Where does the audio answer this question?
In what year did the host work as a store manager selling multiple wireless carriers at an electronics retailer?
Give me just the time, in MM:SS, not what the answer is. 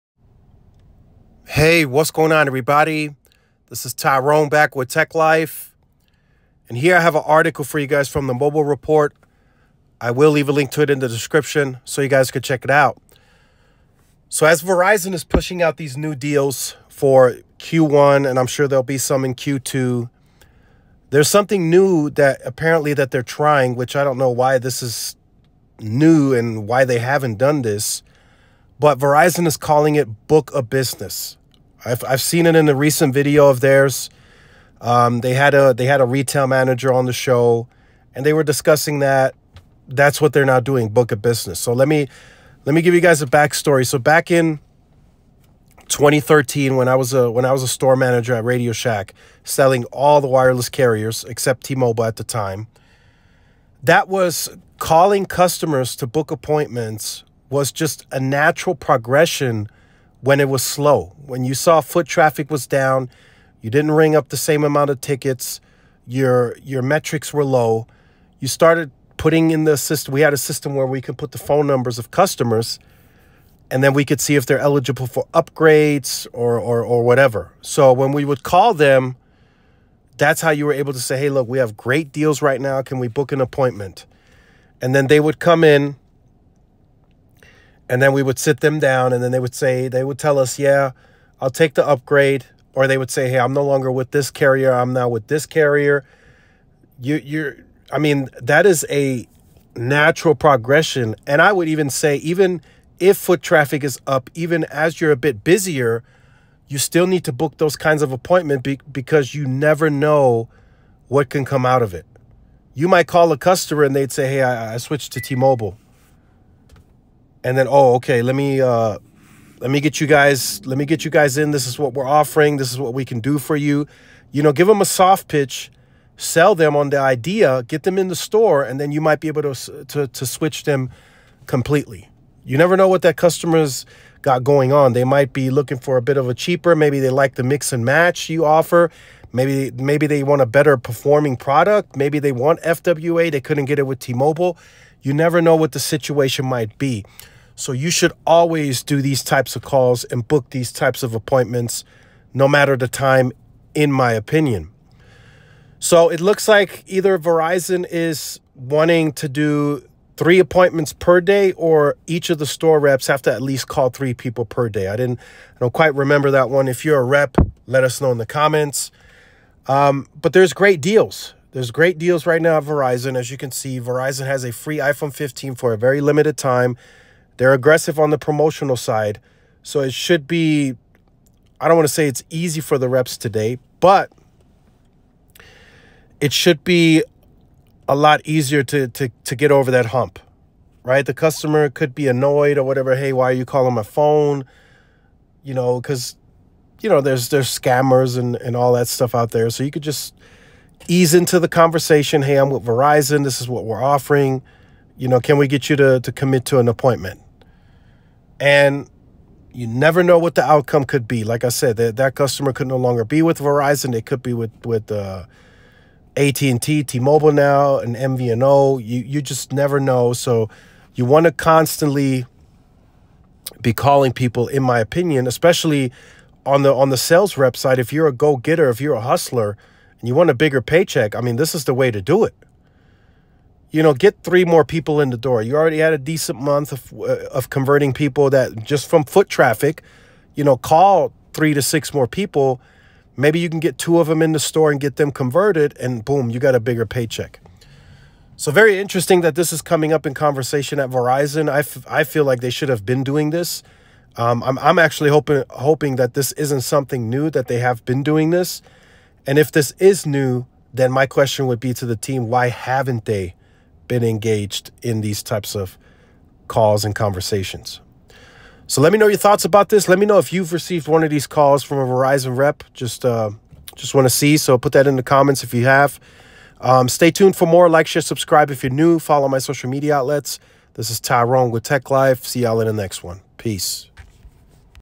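00:45.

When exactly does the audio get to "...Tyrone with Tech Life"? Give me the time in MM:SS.
04:40.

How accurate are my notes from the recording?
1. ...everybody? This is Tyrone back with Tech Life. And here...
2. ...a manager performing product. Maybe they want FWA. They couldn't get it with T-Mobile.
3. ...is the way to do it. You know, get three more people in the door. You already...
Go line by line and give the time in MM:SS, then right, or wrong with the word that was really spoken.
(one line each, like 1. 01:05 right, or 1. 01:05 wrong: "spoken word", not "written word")
1. 00:02 right
2. 02:20 wrong: "better", not "manager"
3. 03:51 right.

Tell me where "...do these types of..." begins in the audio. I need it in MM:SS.
02:28.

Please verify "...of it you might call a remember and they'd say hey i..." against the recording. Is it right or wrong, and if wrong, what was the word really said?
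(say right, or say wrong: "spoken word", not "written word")
wrong: "customer", not "remember".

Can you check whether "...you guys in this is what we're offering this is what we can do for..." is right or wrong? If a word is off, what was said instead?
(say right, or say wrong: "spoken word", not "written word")
right.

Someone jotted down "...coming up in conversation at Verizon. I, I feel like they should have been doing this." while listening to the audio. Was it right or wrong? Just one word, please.
right.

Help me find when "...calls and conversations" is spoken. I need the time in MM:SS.
04:26.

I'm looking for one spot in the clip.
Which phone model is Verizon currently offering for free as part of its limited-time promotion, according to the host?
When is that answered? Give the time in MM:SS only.
02:54.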